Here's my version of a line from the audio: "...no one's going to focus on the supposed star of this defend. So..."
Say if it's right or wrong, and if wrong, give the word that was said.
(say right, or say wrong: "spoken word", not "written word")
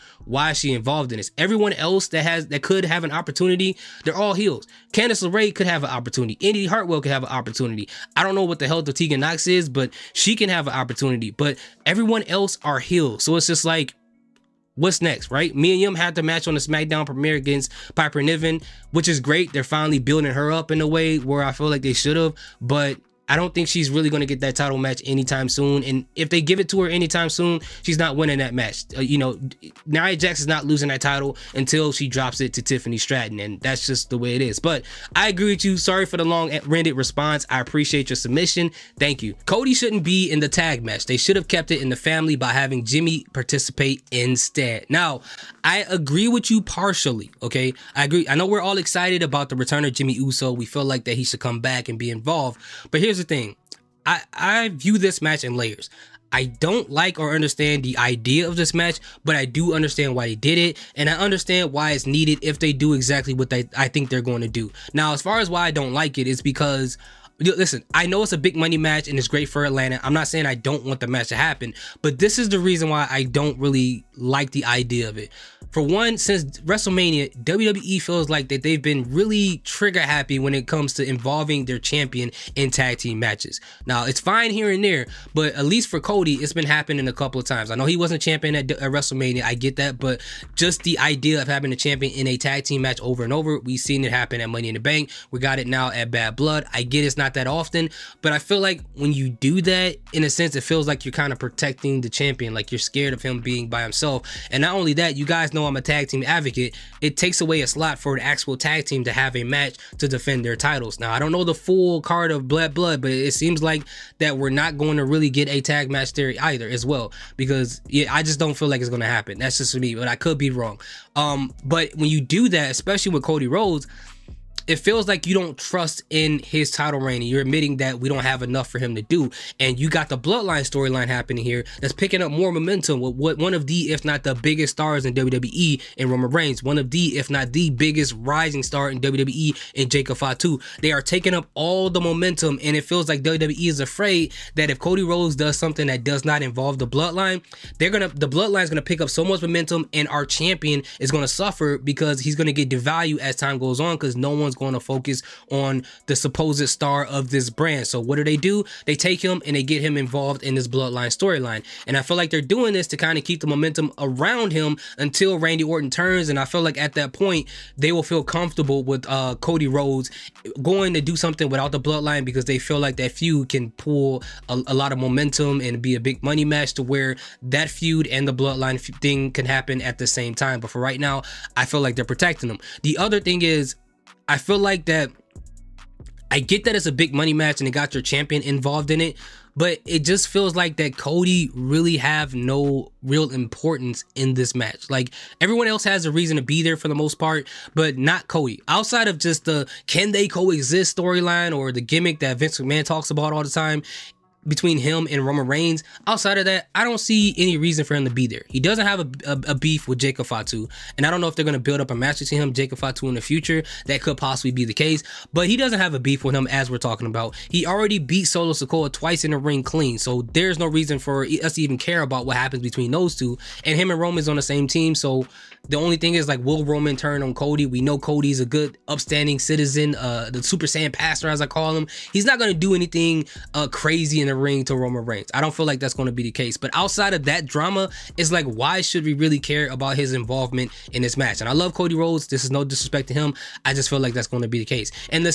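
wrong: "brand", not "defend".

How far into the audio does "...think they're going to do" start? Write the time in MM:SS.
01:03.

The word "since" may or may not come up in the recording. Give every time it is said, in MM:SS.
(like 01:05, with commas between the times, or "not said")
01:16.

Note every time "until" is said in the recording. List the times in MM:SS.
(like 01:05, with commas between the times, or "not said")
00:31, 02:44.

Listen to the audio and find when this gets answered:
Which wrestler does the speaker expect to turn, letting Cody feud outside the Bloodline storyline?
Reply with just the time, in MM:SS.
02:45.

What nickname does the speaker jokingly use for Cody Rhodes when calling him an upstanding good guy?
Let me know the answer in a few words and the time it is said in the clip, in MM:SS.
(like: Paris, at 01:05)
the Super Saiyan pastor, at 03:50.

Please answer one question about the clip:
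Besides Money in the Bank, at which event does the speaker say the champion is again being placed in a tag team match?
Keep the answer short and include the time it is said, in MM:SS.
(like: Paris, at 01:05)
Bad Blood, at 01:36.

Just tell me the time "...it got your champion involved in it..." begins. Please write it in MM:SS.
03:07.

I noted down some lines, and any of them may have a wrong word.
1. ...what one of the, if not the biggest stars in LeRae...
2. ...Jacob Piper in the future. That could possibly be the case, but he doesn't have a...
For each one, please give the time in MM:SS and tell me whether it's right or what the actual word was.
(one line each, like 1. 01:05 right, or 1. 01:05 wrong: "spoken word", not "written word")
1. 02:13 wrong: "WWE", not "LeRae"
2. 03:32 wrong: "Fatu", not "Piper".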